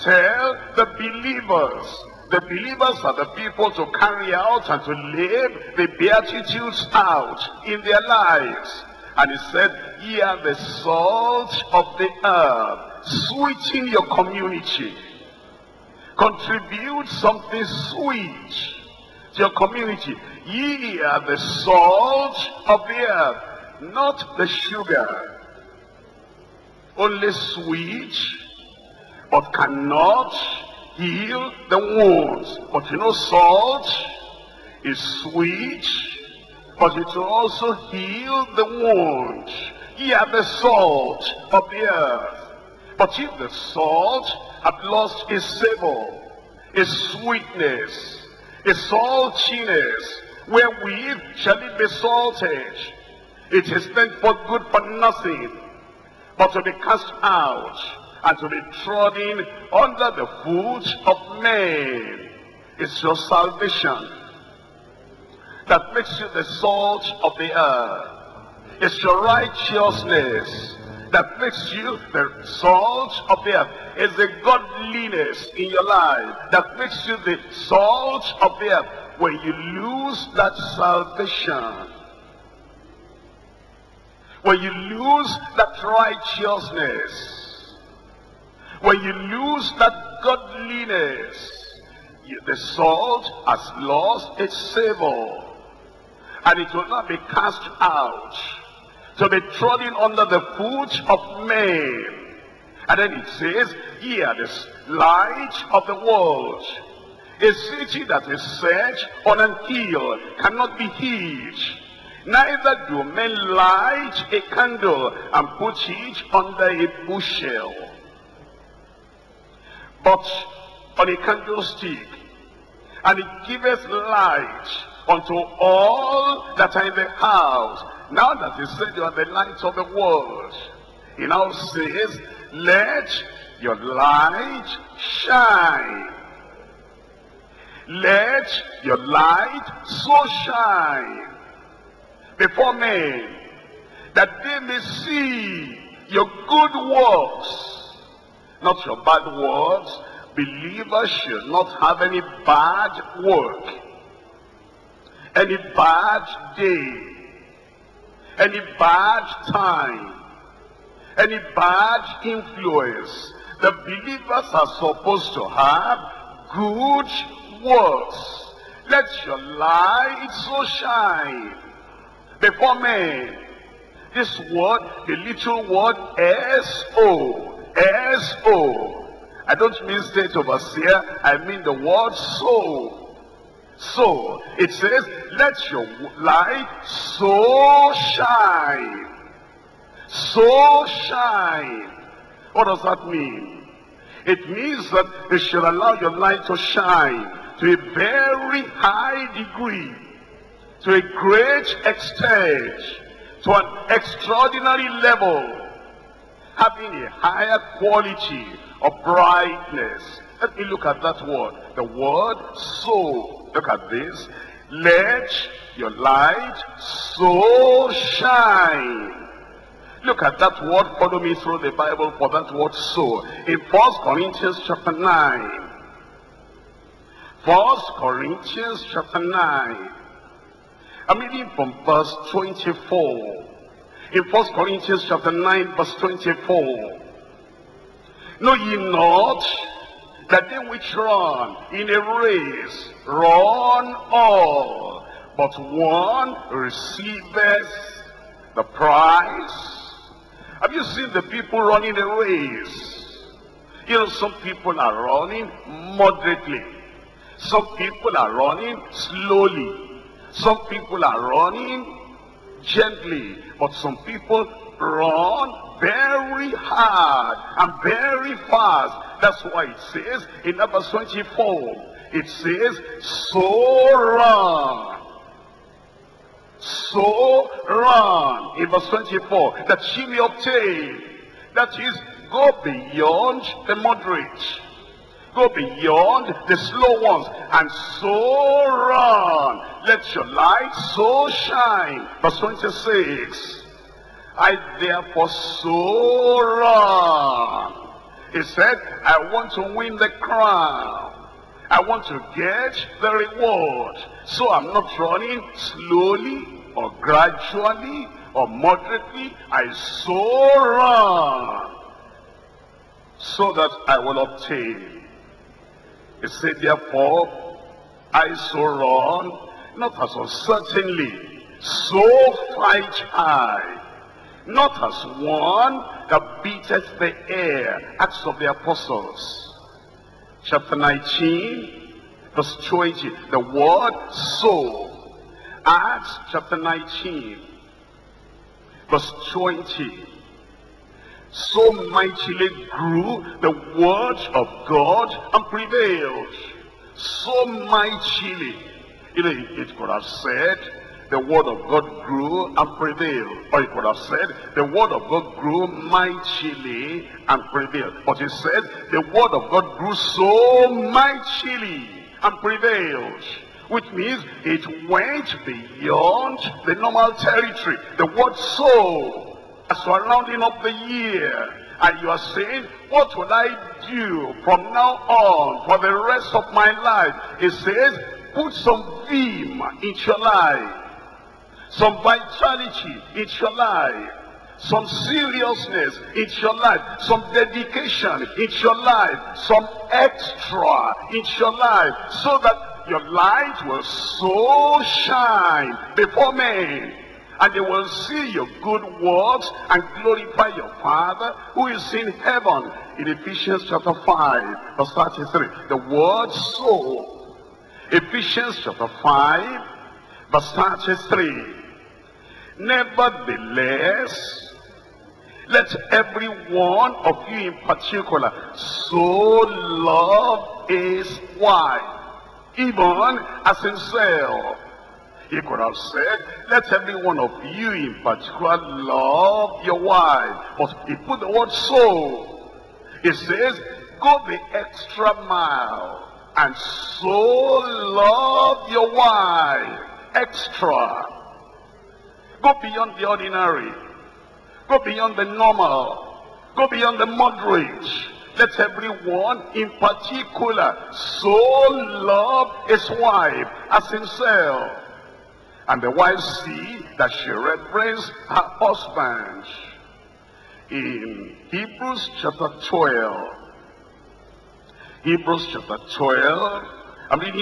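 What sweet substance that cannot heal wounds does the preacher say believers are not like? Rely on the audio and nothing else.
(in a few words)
sugar.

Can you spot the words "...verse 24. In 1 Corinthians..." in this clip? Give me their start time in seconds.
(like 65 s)
231 s.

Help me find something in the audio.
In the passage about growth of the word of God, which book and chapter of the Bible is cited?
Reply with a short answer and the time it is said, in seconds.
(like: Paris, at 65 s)
Acts 19, at 327 s.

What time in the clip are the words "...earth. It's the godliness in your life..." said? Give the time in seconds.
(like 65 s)
73 s.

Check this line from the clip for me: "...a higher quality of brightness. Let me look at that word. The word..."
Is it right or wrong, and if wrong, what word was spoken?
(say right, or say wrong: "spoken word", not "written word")
right.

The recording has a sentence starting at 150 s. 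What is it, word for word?
Believers should not have any bad work, any bad deeds any bad time, any bad influence.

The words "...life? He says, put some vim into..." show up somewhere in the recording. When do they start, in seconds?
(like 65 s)
376 s.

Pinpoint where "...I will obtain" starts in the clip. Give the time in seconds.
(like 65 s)
313 s.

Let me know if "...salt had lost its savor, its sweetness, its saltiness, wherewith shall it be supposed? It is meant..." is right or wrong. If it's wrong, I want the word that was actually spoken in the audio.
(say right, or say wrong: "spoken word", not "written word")
wrong: "salted", not "supposed".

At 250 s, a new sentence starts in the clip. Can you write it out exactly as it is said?
Have you seen the people running a race?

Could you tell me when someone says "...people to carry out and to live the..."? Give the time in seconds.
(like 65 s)
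3 s.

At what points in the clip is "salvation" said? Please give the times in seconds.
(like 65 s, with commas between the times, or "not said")
63 s, 80 s.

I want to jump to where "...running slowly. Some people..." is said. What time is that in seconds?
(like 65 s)
258 s.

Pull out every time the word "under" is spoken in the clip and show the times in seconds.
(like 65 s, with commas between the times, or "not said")
59 s, 99 s, 116 s.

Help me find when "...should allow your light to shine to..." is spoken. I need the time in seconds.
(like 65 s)
195 s.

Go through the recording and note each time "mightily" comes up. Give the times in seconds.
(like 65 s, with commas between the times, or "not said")
341 s, 347 s, 355 s, 360 s.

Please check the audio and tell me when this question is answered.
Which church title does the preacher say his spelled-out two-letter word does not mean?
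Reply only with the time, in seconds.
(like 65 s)
180 s.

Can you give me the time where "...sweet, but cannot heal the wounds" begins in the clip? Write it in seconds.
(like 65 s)
27 s.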